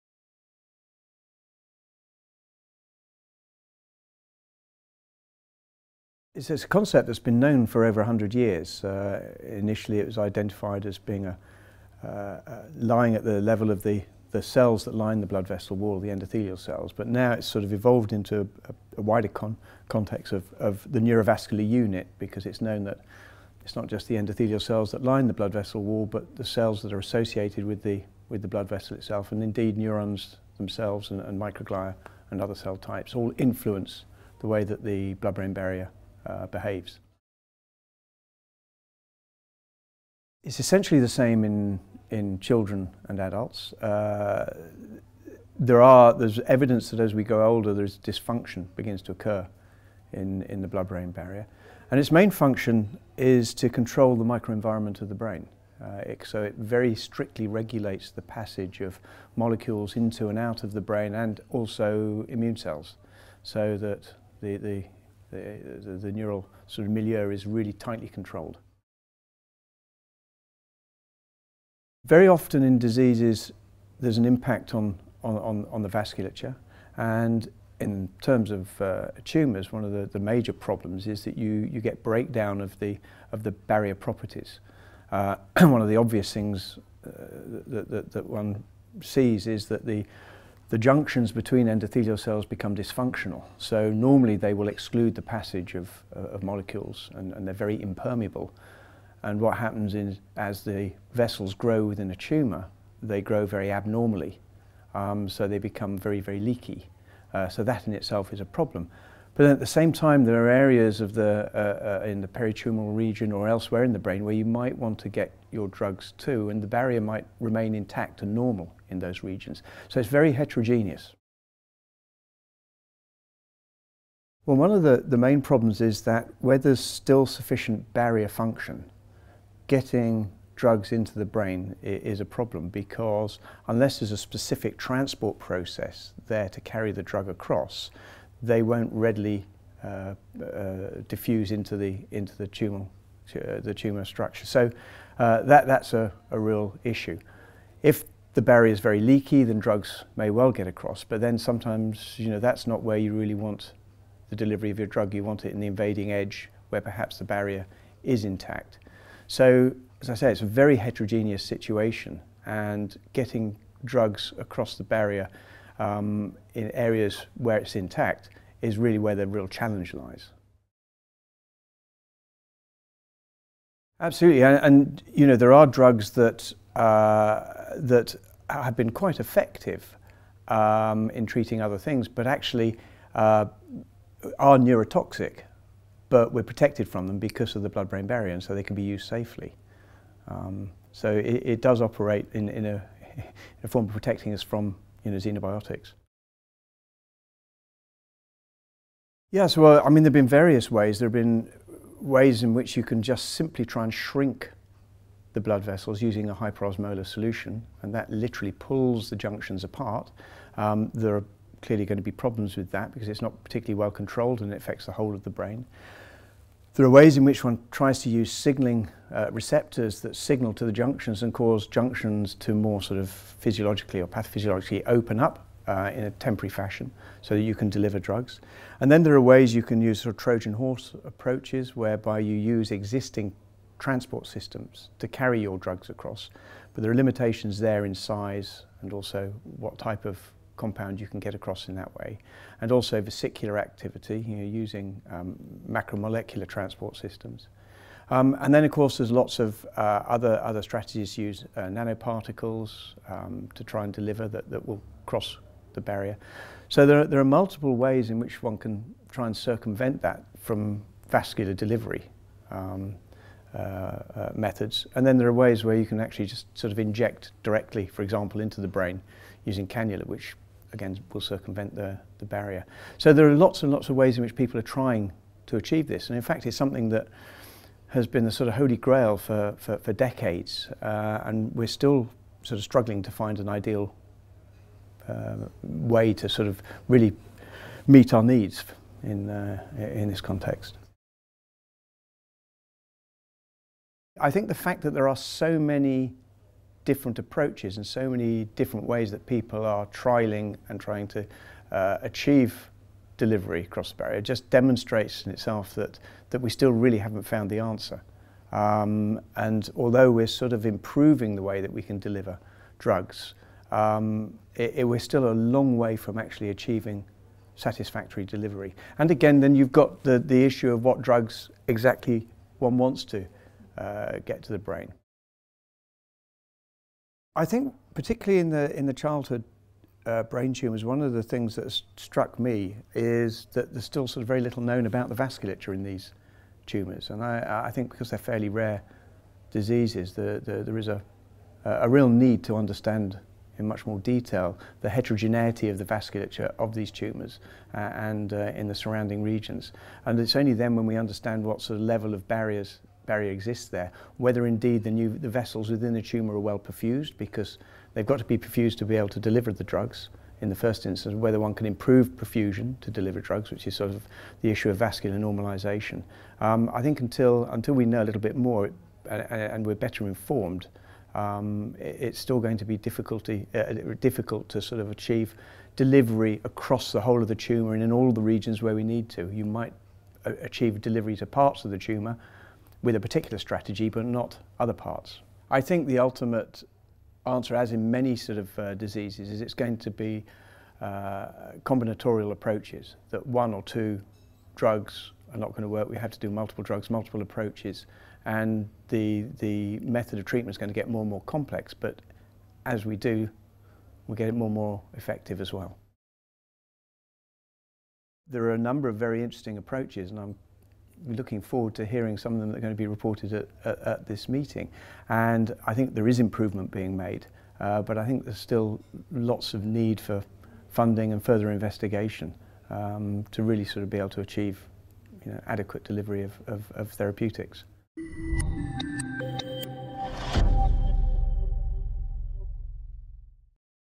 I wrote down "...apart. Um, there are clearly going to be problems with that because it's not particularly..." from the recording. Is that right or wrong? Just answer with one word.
right.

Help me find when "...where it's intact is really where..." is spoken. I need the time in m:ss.
2:47.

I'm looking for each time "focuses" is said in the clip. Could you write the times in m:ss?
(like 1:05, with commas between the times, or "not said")
not said.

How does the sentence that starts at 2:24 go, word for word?
So uh, that that's a, a real issue.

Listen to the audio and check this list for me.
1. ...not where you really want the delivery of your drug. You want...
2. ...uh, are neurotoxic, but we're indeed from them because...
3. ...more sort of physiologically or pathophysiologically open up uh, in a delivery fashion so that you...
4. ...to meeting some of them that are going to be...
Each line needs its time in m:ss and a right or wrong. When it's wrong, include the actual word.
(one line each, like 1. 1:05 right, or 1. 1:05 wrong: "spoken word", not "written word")
1. 2:32 right
2. 3:03 wrong: "protected", not "indeed"
3. 3:42 wrong: "temporary", not "delivery"
4. 6:51 wrong: "hearing", not "meeting".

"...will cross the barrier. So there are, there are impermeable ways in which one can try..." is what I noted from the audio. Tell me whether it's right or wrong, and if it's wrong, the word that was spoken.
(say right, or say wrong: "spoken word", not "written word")
wrong: "multiple", not "impermeable".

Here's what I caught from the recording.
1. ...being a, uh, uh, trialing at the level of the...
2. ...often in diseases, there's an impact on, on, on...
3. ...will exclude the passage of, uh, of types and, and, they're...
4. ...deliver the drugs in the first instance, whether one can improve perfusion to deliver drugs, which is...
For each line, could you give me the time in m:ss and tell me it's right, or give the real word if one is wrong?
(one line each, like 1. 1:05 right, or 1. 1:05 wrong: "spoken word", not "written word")
1. 0:10 wrong: "lying", not "trialing"
2. 1:12 right
3. 1:34 wrong: "molecules", not "types"
4. 5:59 right.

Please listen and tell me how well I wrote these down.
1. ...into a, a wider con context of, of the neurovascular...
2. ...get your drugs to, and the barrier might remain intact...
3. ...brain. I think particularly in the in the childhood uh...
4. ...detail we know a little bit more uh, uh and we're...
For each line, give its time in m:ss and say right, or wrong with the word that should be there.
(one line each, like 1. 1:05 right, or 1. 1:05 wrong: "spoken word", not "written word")
1. 0:18 right
2. 1:55 right
3. 5:24 right
4. 6:07 wrong: "until", not "detail".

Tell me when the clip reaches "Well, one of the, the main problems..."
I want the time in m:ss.
2:04.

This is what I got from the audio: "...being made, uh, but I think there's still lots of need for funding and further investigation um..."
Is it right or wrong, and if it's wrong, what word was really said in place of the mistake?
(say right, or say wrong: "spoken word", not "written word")
right.